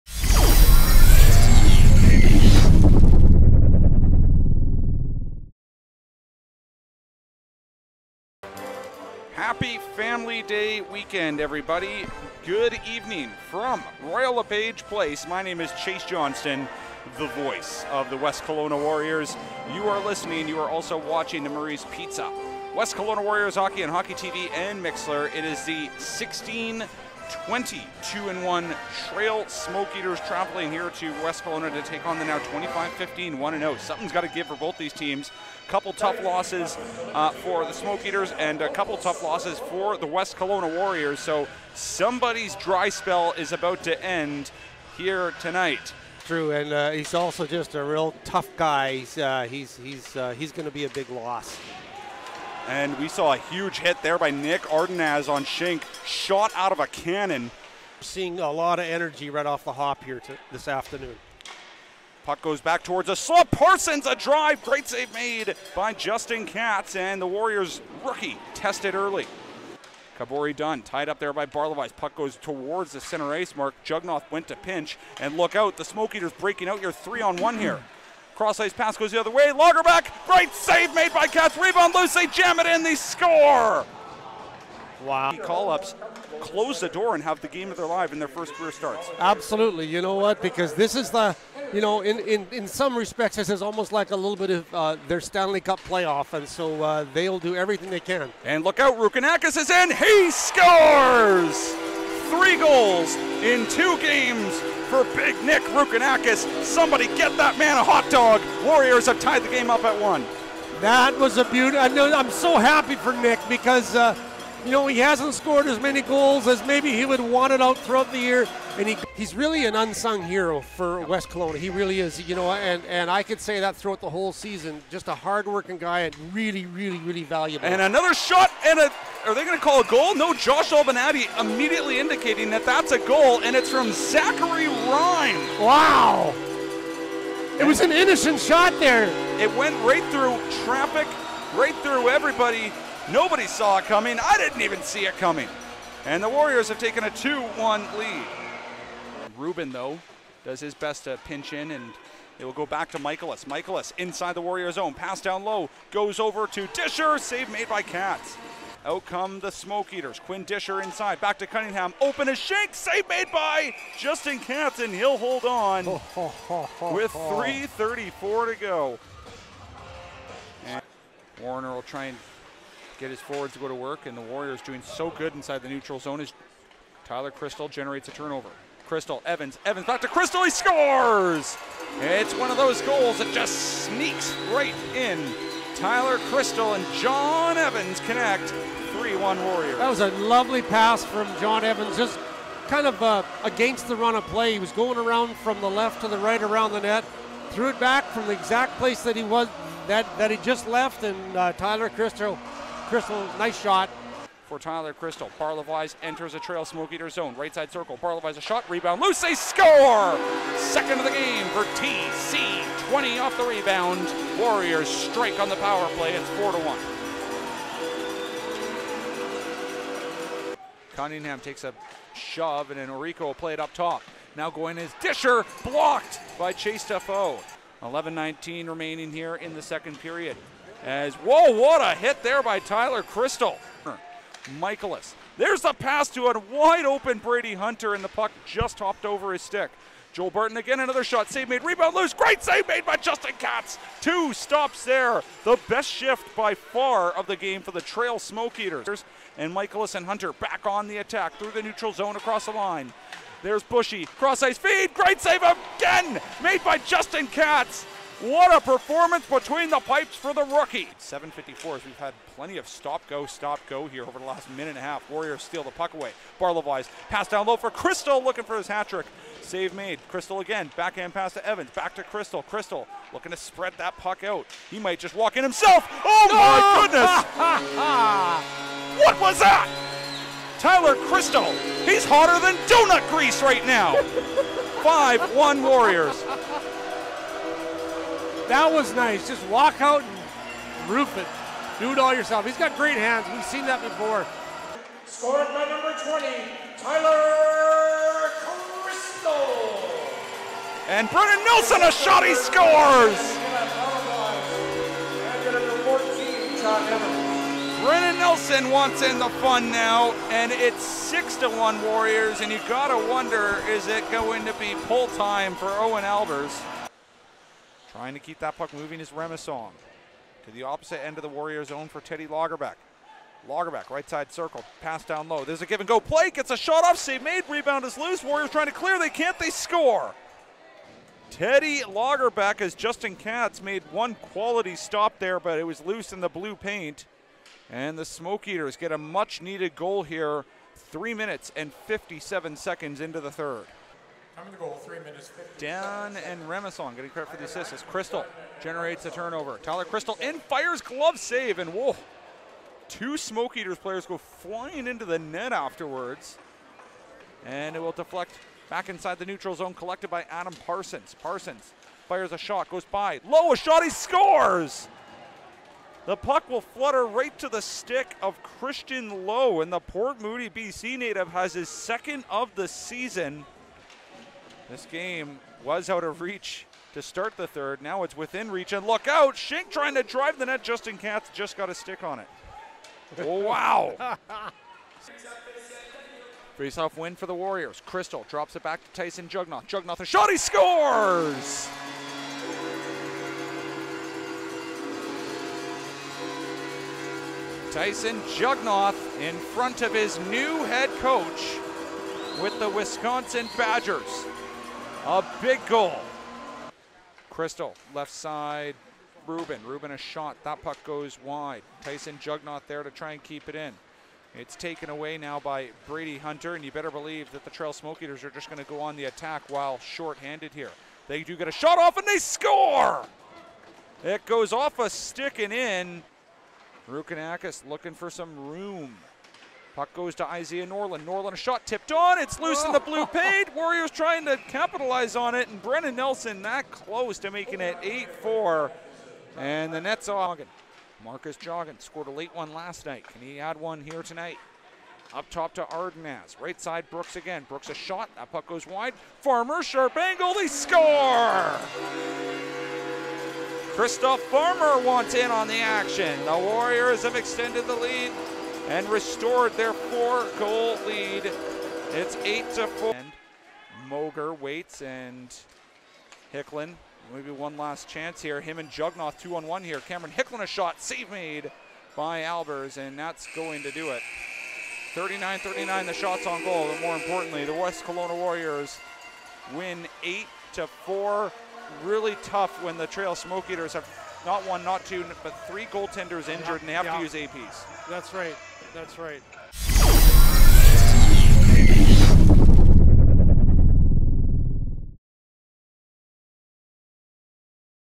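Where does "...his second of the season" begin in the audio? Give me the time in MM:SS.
06:11.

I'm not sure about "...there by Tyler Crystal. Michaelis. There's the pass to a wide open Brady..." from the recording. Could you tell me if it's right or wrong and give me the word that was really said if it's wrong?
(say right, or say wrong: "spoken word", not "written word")
right.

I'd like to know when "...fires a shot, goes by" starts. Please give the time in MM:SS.
06:02.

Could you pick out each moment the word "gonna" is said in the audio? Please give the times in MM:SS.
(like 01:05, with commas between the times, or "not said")
not said.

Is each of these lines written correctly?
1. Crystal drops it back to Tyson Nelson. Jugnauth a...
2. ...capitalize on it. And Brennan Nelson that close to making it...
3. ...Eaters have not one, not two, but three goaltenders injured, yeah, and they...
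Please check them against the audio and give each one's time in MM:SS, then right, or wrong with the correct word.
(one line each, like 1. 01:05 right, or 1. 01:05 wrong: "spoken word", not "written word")
1. 06:27 wrong: "Jugnauth", not "Nelson"
2. 07:14 right
3. 08:03 right.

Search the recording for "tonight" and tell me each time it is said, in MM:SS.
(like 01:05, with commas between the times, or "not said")
00:45, 07:24.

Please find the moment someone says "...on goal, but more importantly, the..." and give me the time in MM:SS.
07:56.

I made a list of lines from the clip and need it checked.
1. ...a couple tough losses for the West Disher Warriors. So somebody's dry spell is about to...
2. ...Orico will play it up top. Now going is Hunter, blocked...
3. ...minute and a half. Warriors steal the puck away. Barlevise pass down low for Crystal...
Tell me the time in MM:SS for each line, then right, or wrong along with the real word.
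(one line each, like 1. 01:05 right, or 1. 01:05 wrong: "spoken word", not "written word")
1. 00:38 wrong: "Kelowna", not "Disher"
2. 03:42 wrong: "Disher", not "Hunter"
3. 04:24 right.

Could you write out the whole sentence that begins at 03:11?
Just kind of uh, against the run of play.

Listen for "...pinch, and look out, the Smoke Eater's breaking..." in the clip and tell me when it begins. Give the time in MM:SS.
01:14.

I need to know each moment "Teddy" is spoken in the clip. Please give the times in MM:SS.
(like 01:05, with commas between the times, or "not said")
05:21, 05:31.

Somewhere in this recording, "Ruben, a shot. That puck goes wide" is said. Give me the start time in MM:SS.
06:49.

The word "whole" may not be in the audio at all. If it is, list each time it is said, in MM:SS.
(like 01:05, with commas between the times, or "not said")
02:04.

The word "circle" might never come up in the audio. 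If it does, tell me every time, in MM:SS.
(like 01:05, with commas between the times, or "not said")
03:27, 05:24.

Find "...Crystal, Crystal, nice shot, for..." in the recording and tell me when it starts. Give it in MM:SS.
03:21.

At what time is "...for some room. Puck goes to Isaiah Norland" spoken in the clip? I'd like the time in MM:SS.
07:07.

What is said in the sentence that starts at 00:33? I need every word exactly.
Something's got to give for both these teams.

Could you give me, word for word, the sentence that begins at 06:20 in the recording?
Justin Katz just got a stick on it.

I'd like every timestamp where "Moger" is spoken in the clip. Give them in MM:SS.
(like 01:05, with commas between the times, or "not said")
07:43.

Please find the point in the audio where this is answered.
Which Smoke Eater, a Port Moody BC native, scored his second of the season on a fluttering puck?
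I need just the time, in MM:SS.
06:08.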